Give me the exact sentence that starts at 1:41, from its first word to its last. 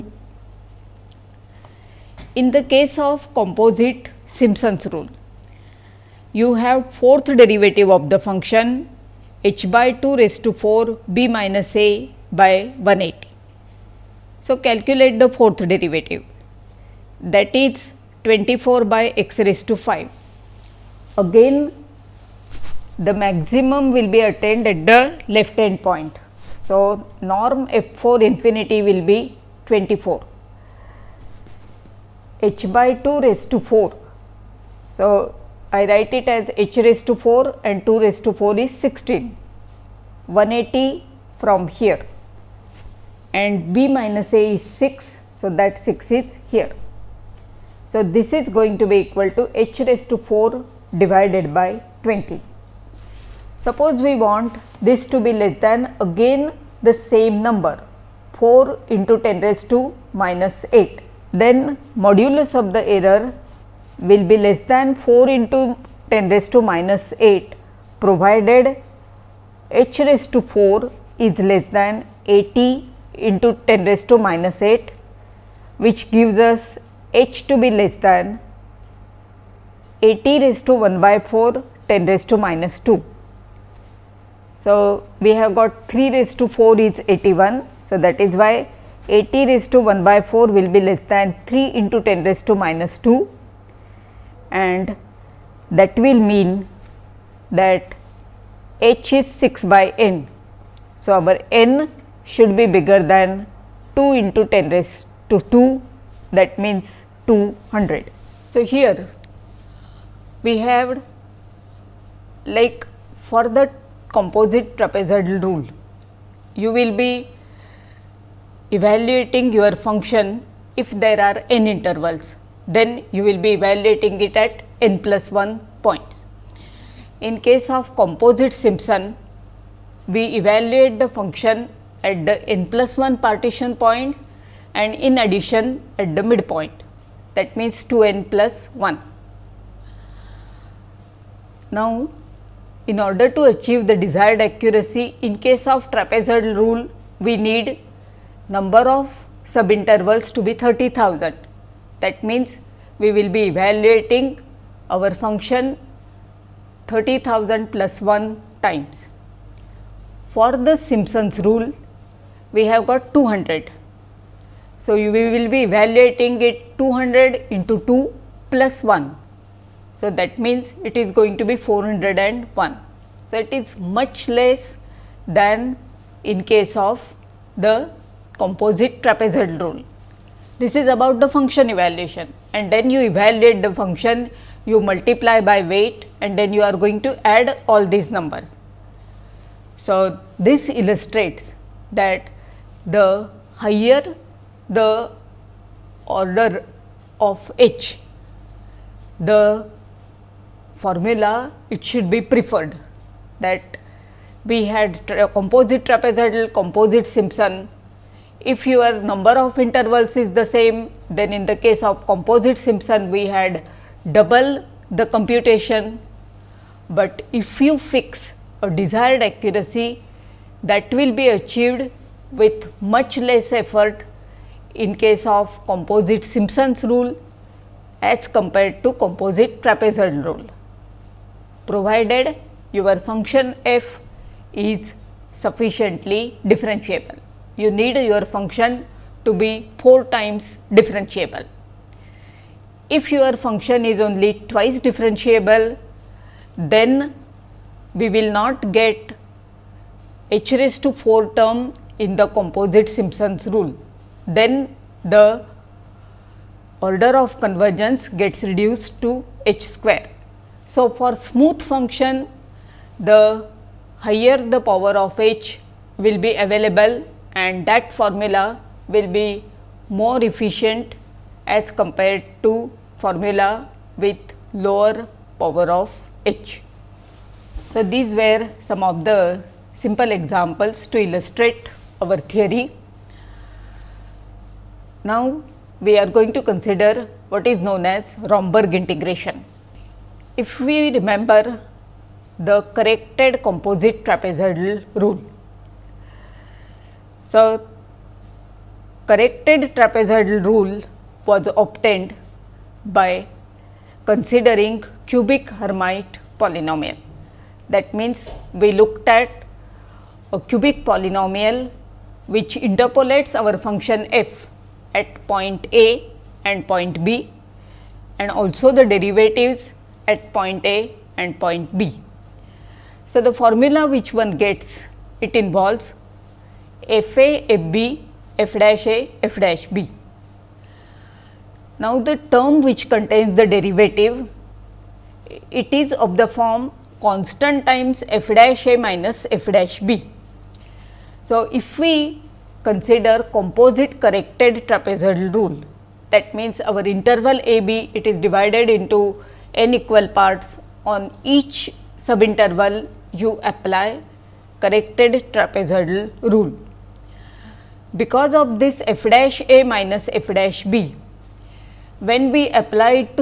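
So, our n should be bigger than 2 into 10 raised to 2 that means 200.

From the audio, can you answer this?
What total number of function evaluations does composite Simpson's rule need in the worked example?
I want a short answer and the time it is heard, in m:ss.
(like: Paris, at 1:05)
401, at 2:51.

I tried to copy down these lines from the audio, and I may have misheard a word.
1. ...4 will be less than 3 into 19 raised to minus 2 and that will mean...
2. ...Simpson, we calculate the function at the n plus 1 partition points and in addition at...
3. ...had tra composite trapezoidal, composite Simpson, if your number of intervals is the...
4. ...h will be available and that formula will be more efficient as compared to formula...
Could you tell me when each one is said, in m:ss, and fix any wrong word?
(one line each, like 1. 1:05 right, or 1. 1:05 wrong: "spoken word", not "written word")
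1. 1:30 wrong: "10", not "19"
2. 2:08 wrong: "evaluate", not "calculate"
3. 3:24 right
4. 4:25 right.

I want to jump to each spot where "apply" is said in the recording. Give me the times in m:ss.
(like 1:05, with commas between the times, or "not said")
5:53, 6:02.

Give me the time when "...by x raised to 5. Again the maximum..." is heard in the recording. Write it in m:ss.
0:18.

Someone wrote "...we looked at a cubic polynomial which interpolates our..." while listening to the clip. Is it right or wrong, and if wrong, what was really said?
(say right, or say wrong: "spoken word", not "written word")
right.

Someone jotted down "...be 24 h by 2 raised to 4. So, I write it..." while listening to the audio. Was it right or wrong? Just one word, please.
right.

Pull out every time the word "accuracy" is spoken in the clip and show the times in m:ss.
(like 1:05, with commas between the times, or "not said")
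2:24, 3:39.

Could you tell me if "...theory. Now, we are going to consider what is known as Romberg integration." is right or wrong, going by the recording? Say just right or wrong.
right.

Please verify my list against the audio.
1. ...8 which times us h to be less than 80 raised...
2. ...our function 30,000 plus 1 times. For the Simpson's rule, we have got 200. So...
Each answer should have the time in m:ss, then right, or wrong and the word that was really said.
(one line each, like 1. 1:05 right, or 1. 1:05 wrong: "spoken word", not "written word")
1. 1:14 wrong: "gives", not "times"
2. 2:34 right.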